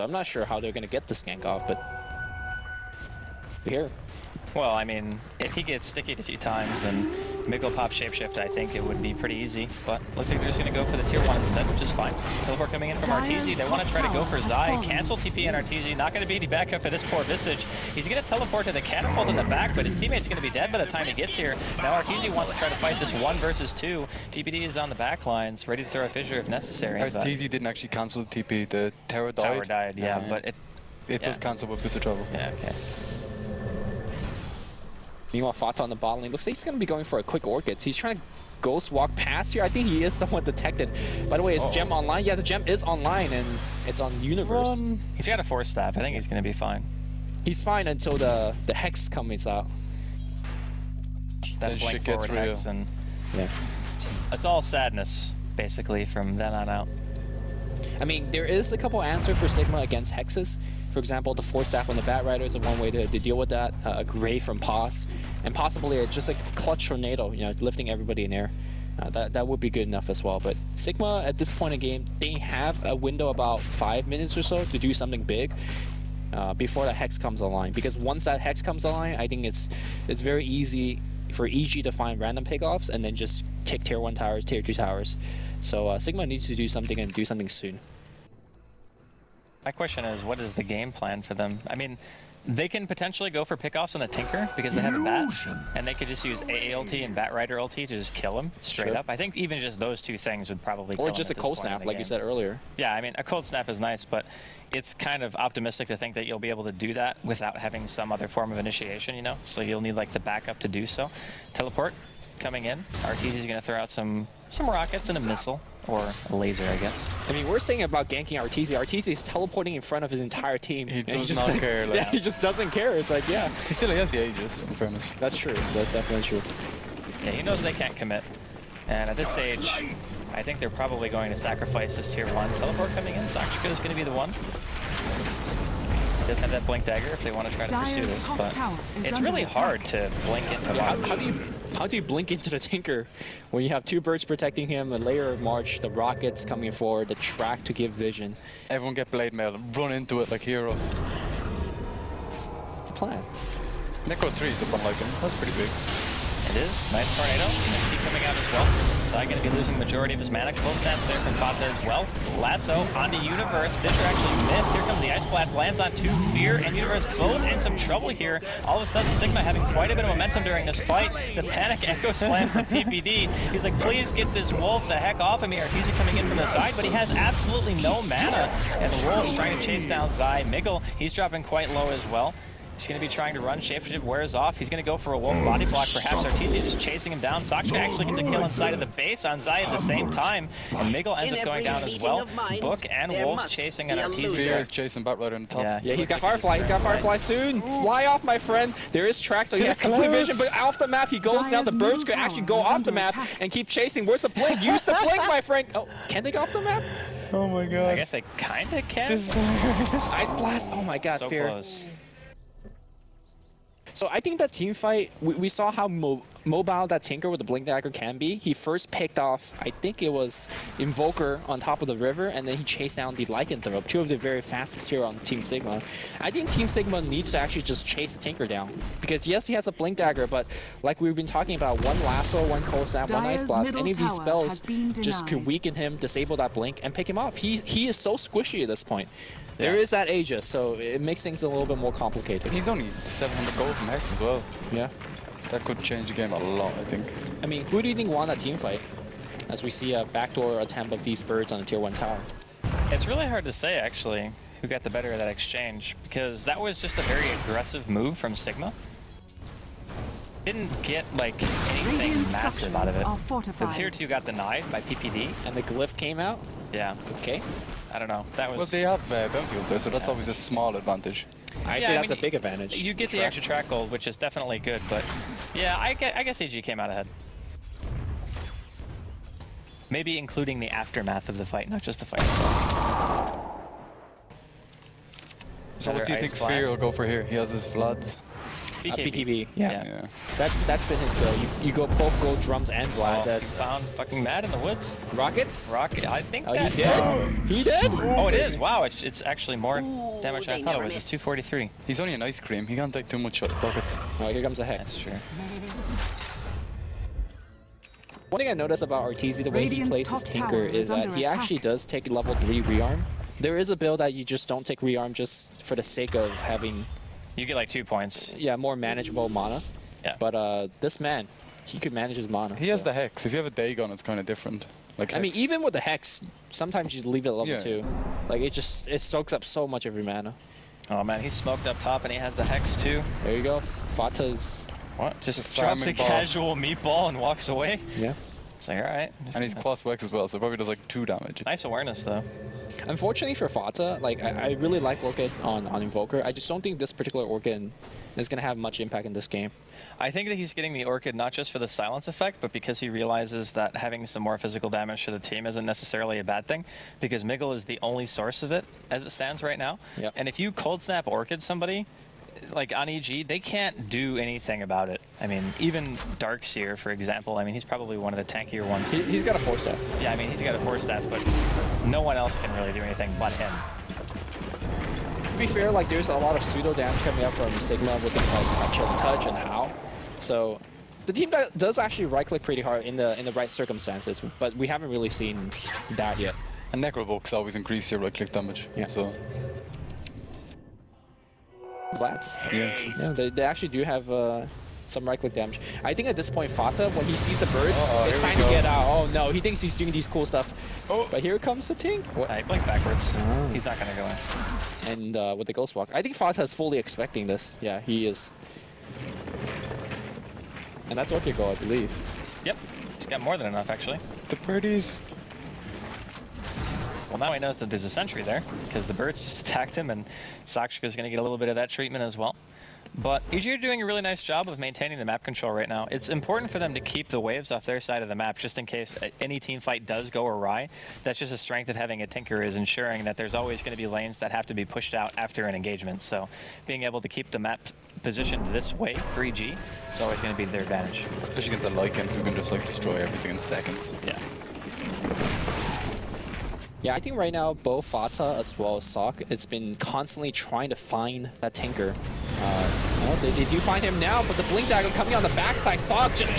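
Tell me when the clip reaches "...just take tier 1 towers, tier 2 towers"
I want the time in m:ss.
1:23.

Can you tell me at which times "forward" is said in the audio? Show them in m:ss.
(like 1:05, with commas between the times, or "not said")
0:52, 2:26.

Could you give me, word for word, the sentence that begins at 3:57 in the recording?
He, he is so squishy at this point.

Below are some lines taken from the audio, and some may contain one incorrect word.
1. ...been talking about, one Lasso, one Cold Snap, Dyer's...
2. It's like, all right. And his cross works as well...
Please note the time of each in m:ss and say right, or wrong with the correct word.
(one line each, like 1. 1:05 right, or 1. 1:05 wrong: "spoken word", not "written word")
1. 3:51 right
2. 5:38 right.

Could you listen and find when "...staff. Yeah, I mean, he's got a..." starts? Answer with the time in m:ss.
6:09.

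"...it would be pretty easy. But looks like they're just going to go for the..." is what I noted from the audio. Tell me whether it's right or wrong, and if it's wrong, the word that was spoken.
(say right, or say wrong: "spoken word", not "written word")
right.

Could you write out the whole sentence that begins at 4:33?
extra track gold, which is definitely good, but yeah, I guess, I guess EG came out ahead.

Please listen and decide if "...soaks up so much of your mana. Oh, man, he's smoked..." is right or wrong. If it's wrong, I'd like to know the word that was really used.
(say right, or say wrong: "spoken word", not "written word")
right.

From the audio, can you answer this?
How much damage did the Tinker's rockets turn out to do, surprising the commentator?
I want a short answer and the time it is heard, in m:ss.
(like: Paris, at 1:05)
243, at 5:01.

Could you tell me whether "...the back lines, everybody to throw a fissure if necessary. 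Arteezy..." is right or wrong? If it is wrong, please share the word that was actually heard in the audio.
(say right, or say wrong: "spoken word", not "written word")
wrong: "ready", not "everybody".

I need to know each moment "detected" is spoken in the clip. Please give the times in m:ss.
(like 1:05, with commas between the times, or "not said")
0:40.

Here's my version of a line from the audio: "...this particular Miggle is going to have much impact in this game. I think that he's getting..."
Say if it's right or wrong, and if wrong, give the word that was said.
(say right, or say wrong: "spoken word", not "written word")
wrong: "Orchid", not "Miggle".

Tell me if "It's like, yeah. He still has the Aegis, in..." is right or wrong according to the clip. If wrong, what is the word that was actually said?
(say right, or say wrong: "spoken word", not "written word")
right.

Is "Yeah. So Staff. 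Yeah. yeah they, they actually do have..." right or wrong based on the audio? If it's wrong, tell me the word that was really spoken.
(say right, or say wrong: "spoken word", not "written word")
wrong: "Vlads", not "Staff".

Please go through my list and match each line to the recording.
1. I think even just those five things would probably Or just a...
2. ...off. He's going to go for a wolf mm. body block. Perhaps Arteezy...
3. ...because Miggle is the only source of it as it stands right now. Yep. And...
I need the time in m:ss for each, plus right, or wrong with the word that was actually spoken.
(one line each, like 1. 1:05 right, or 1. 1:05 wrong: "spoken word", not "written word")
1. 1:39 wrong: "two", not "five"
2. 3:04 right
3. 5:57 right.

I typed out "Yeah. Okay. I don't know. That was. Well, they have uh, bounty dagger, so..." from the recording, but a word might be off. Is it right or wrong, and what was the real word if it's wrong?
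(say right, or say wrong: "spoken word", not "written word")
wrong: "hunter", not "dagger".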